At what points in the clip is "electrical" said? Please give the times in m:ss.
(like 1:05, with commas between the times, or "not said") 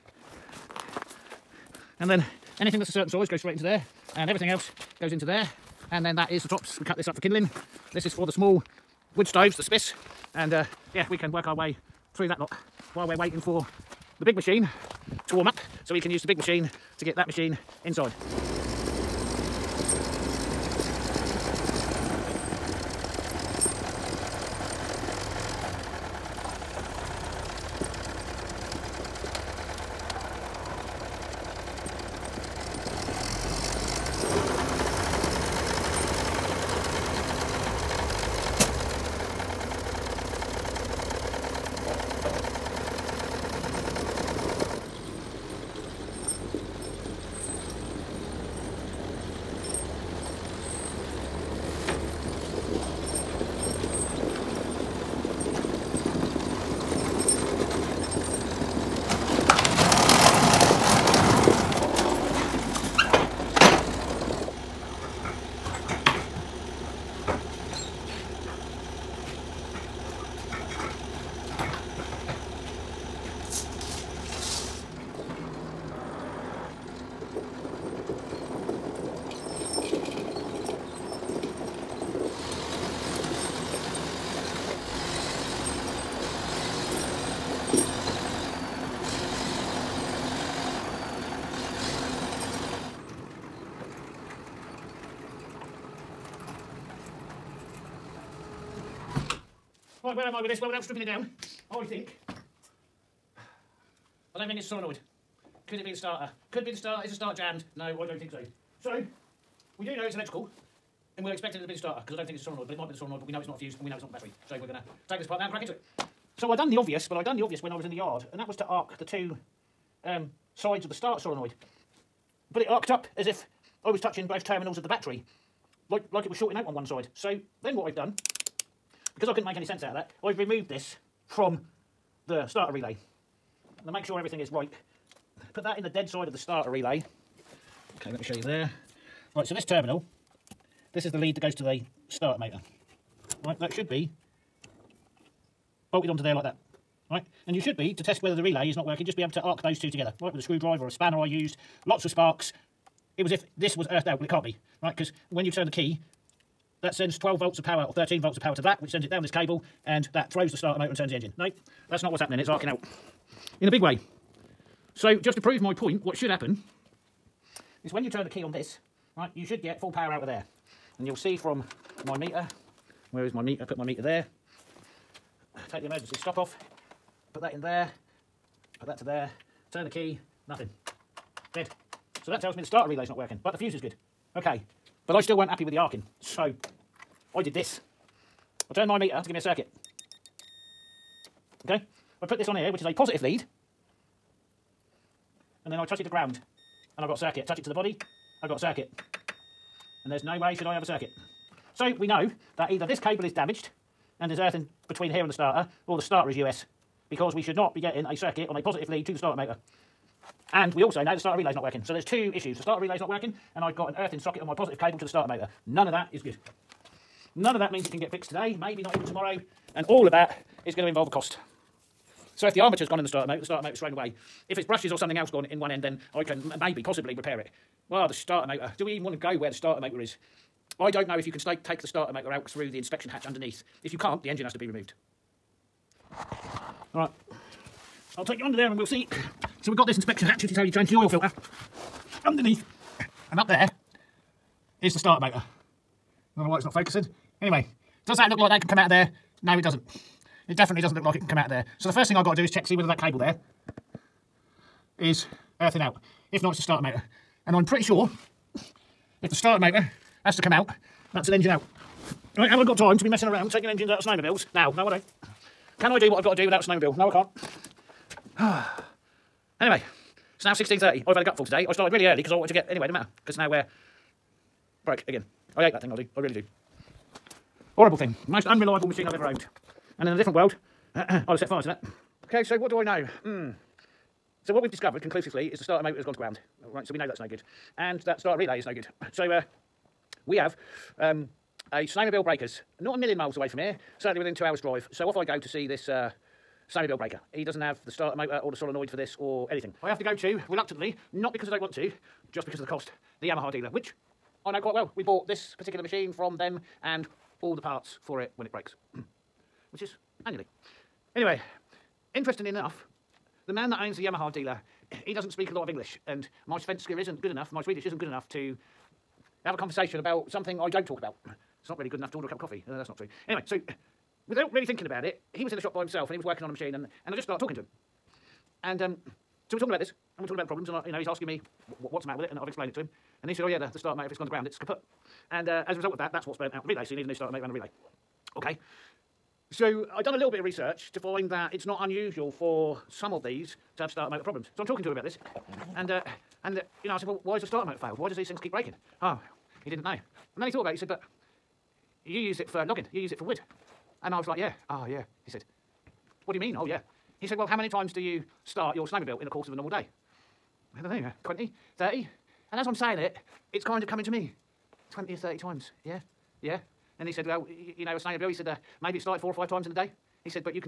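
1:50.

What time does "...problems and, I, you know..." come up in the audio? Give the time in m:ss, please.
5:30.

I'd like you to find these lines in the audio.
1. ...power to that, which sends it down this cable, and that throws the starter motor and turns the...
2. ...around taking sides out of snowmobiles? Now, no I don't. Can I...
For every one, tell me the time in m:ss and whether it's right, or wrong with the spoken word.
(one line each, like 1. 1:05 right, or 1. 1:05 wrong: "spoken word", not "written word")
1. 2:38 right
2. 4:23 wrong: "engines", not "sides".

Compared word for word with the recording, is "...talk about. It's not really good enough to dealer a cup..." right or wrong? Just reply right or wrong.
wrong.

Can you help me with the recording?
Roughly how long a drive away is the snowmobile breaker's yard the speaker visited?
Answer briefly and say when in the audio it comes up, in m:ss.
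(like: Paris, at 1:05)
2 hours, at 4:54.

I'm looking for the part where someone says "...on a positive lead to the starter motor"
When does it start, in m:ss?
3:28.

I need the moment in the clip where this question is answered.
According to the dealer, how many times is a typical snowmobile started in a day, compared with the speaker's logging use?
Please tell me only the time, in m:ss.
6:09.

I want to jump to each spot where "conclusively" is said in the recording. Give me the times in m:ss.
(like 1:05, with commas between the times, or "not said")
4:45.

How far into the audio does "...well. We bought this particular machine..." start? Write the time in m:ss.
5:04.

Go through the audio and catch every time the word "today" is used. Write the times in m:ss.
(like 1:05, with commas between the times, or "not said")
3:38, 4:31.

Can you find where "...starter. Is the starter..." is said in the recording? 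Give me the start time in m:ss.
1:46.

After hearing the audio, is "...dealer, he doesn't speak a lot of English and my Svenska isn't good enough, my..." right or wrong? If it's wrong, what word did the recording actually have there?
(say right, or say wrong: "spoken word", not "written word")
right.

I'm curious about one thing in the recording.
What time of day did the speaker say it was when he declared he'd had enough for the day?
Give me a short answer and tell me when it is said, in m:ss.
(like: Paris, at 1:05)
16:30, at 4:30.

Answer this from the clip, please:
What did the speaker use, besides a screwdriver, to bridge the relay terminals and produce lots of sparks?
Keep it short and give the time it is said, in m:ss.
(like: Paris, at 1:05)
a spanner, at 2:30.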